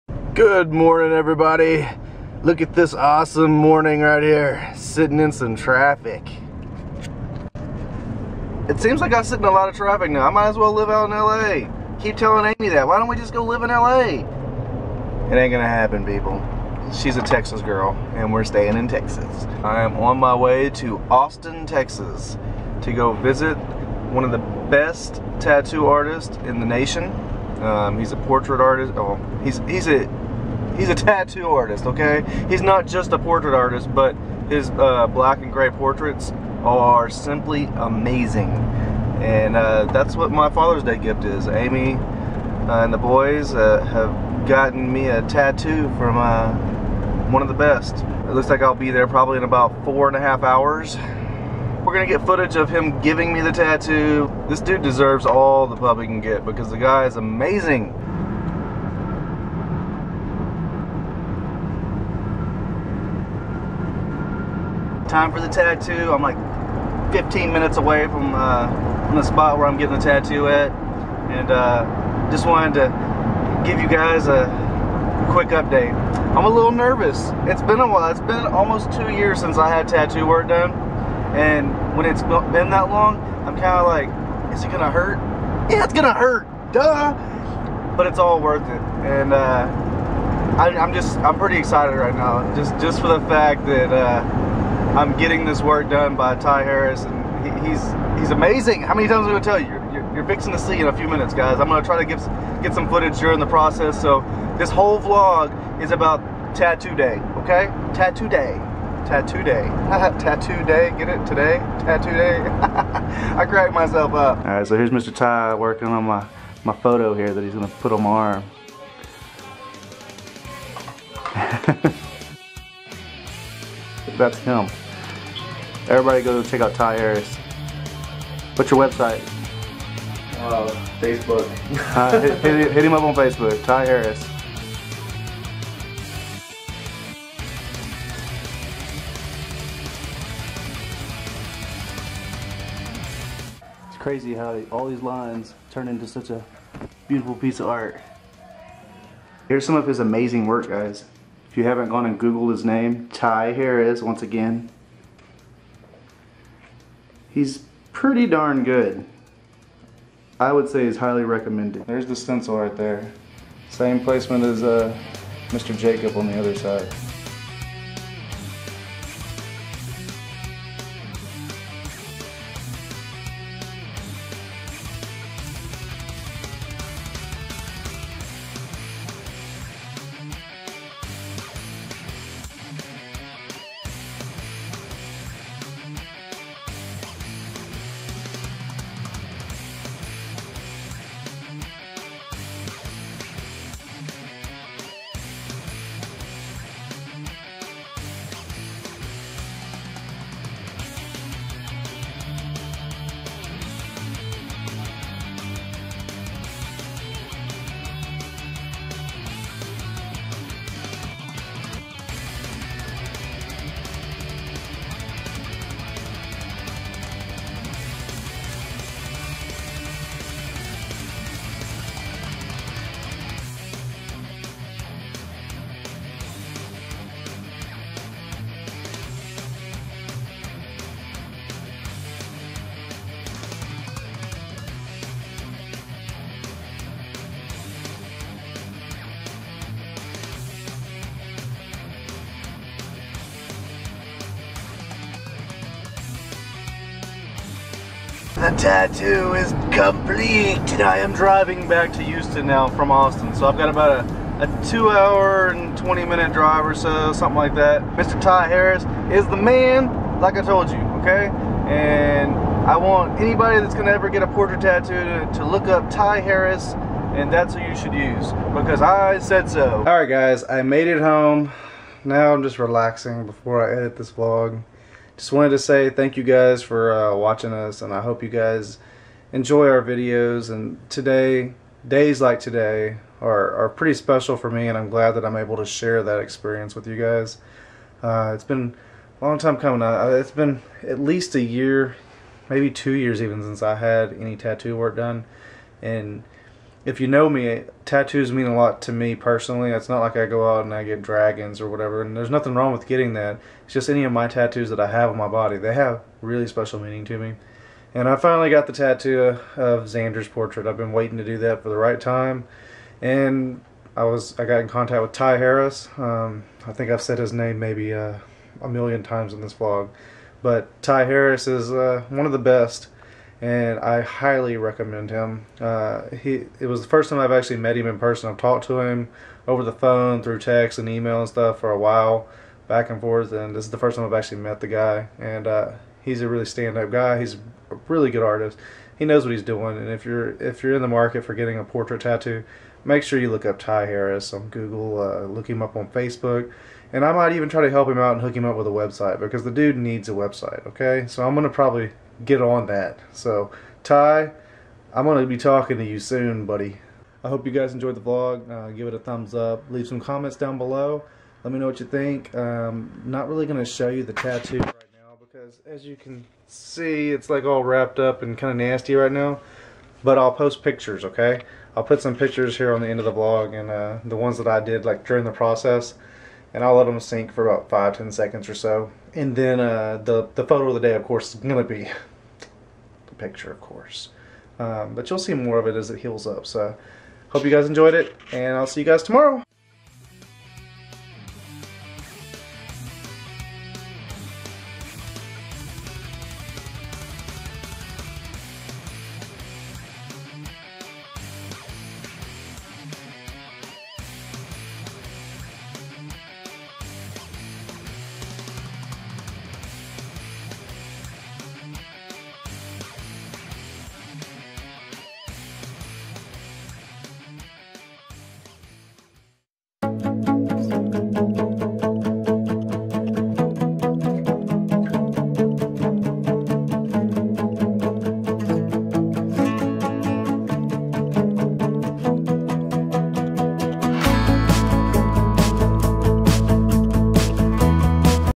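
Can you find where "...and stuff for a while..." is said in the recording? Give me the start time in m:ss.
5:31.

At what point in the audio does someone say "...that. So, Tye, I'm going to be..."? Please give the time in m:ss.
5:52.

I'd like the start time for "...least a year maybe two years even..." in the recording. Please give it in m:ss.
4:50.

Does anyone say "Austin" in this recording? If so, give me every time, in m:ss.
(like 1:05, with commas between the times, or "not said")
0:21, 4:12.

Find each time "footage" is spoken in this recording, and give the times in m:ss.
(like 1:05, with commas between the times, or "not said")
0:52, 1:42.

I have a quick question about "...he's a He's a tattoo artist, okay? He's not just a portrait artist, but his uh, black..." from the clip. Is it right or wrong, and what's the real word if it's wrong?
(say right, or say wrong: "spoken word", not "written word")
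right.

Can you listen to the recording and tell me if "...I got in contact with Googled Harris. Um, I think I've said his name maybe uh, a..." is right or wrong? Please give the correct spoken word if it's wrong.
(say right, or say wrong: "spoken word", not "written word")
wrong: "Tye", not "Googled".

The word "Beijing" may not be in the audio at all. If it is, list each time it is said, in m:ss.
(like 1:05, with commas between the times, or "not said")
not said.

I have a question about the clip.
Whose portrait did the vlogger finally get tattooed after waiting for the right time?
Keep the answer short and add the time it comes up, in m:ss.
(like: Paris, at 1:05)
Xander, at 5:09.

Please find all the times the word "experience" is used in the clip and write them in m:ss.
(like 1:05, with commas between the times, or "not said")
4:46.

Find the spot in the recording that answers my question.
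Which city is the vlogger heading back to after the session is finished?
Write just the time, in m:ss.
4:12.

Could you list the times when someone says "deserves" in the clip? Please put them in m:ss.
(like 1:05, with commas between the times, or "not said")
0:54.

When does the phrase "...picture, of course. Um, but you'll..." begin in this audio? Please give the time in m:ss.
6:23.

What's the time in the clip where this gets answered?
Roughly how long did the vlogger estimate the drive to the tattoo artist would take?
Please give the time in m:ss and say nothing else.
0:49.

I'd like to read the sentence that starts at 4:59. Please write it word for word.
It's not like I go out and I get dragons or whatever, and there's nothing wrong with getting that.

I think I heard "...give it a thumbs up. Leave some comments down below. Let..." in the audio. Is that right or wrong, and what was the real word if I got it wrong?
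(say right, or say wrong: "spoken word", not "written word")
right.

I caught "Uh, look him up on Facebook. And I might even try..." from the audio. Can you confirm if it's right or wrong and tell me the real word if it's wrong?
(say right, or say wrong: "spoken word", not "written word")
right.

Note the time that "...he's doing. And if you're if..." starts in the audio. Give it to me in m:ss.
5:39.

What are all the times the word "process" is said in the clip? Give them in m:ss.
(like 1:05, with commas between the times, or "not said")
1:43, 6:15.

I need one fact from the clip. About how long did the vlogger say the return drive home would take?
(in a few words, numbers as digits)
2 hours 20 minutes.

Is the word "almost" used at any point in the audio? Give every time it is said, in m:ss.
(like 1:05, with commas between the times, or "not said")
1:18.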